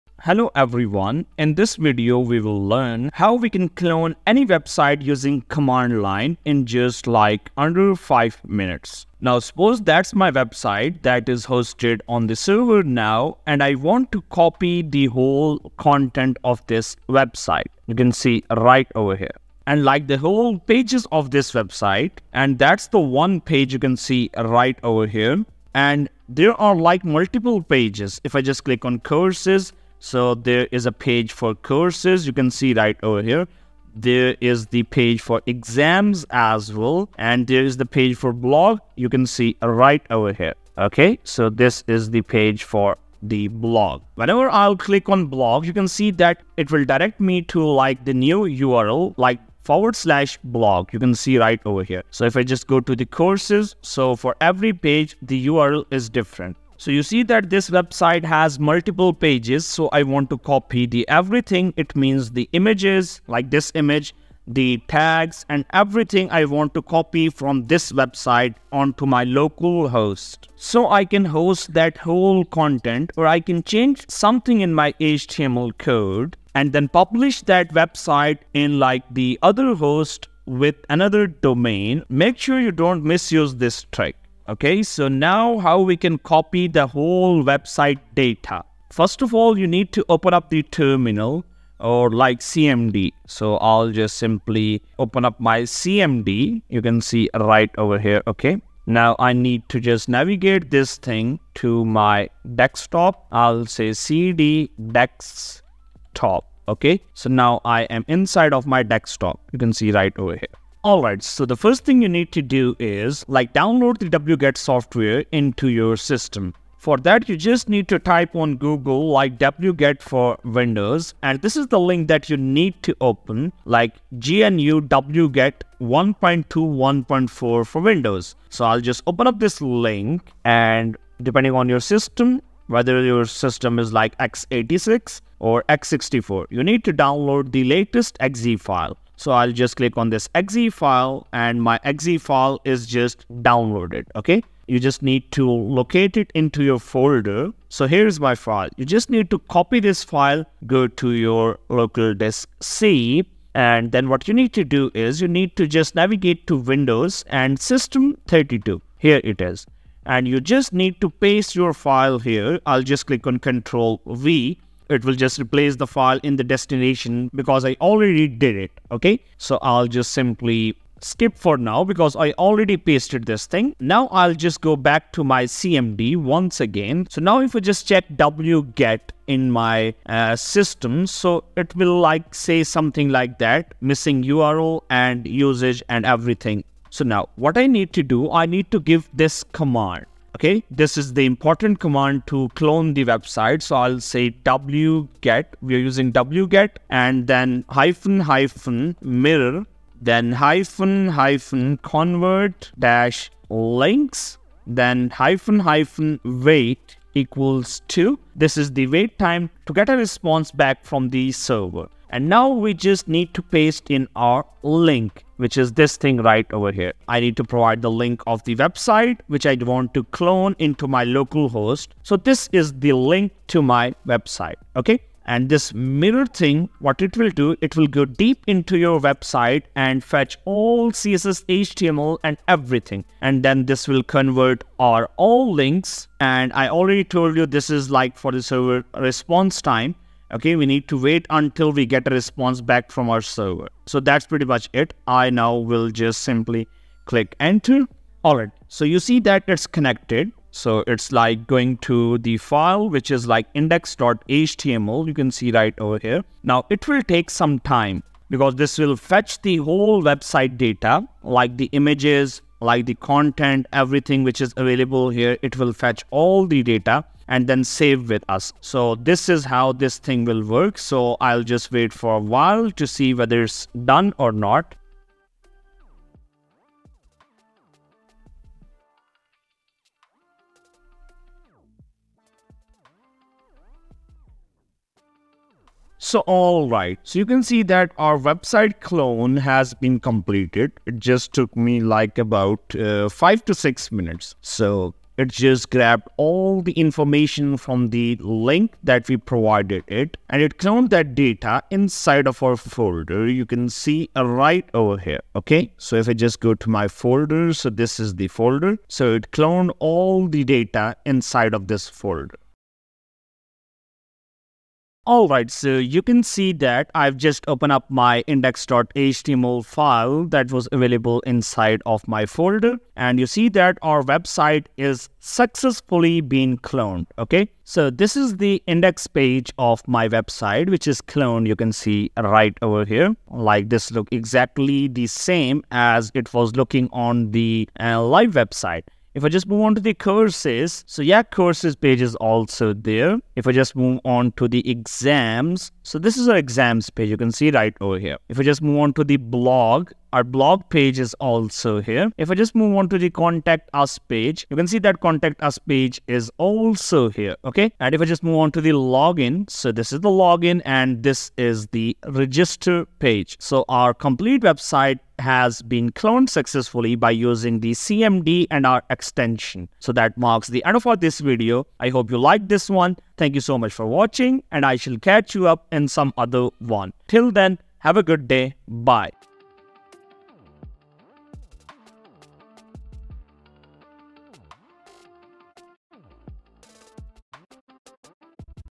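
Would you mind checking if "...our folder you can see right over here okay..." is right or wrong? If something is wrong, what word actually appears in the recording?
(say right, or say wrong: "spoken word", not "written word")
right.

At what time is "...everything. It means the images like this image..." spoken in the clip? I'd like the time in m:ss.
1:01.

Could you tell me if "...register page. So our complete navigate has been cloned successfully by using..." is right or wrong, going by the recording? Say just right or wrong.
wrong.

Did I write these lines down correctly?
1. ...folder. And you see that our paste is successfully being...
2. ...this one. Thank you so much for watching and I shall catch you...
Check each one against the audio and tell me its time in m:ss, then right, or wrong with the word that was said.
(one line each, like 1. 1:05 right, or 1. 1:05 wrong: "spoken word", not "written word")
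1. 5:22 wrong: "website", not "paste"
2. 6:12 right.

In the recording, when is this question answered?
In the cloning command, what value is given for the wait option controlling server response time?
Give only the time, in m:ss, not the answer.
3:27.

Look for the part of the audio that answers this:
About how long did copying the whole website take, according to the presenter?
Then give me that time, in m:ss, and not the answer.
4:53.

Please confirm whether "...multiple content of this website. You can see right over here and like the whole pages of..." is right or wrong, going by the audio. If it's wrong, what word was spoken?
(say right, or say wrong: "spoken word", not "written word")
wrong: "whole", not "multiple".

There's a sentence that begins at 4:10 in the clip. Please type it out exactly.
So it's like going to the file, which is like index.html.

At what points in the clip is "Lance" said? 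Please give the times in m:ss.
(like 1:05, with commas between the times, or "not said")
not said.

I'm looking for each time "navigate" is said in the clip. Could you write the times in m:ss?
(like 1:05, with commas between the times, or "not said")
1:40, 2:35.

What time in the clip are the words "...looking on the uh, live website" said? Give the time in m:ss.
5:36.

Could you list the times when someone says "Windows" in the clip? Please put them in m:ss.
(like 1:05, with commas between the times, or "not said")
2:00, 2:07, 2:36.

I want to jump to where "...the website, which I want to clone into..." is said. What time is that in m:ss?
3:38.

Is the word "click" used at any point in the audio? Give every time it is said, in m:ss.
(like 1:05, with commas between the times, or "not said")
0:28, 0:44, 2:19, 2:43, 4:07.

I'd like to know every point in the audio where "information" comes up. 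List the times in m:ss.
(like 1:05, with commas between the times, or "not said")
4:56.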